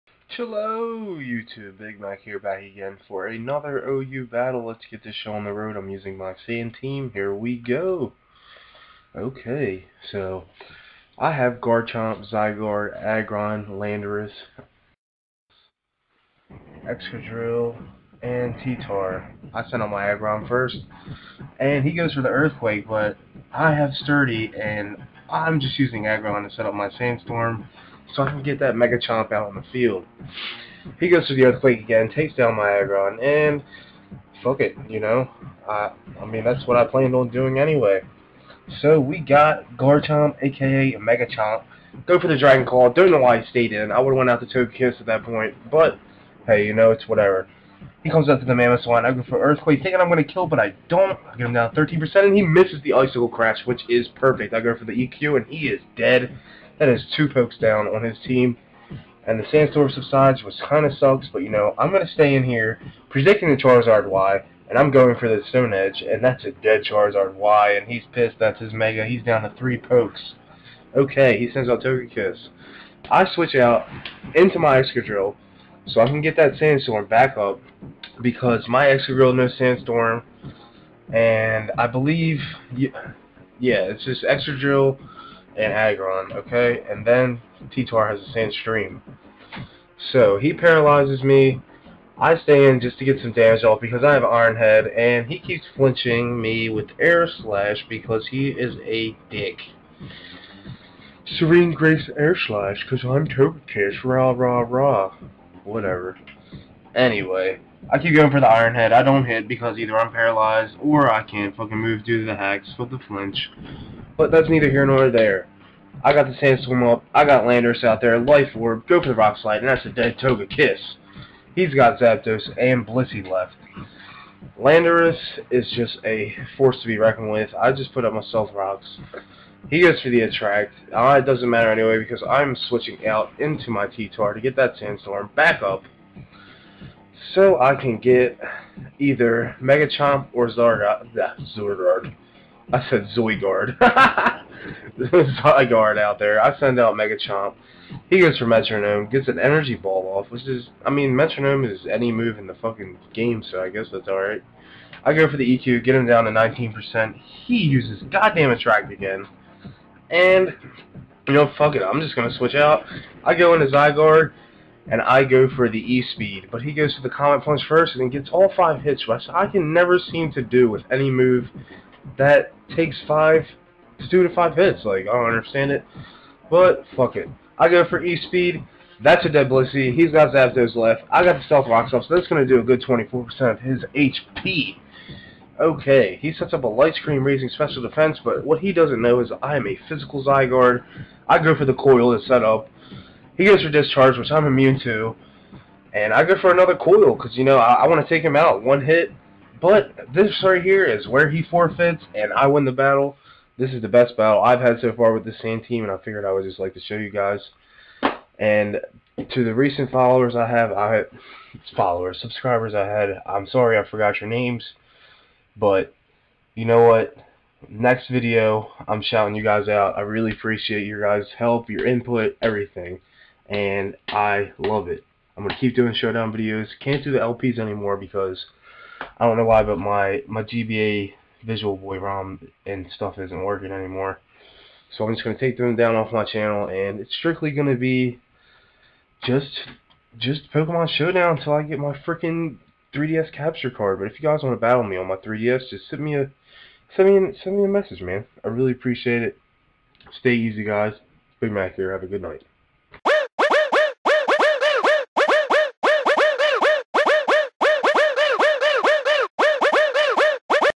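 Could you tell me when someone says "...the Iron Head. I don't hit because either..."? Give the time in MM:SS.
01:48.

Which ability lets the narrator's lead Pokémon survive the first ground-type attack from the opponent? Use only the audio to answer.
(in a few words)
Sturdy.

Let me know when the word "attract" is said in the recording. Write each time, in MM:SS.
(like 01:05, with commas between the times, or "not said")
02:10, 02:38.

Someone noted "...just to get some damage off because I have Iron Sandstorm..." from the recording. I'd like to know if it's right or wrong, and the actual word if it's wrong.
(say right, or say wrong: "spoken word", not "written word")
wrong: "Head", not "Sandstorm".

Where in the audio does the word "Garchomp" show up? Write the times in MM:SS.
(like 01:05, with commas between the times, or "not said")
00:11, 00:39.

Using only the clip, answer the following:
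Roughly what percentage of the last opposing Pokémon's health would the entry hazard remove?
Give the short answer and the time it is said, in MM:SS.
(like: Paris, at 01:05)
24%, at 03:02.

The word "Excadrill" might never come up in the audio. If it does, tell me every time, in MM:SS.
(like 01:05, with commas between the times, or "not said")
00:16, 01:14, 01:18, 01:24.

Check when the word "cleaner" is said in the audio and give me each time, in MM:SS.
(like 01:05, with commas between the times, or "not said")
not said.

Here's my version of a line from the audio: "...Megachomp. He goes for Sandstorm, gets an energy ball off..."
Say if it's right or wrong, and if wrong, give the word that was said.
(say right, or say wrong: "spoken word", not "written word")
wrong: "Metronome", not "Sandstorm".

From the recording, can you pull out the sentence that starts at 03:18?
One hit, but this right here is where he forfeits, and I win the battle.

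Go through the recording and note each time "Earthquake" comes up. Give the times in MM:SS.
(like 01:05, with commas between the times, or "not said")
00:22, 00:31, 00:49.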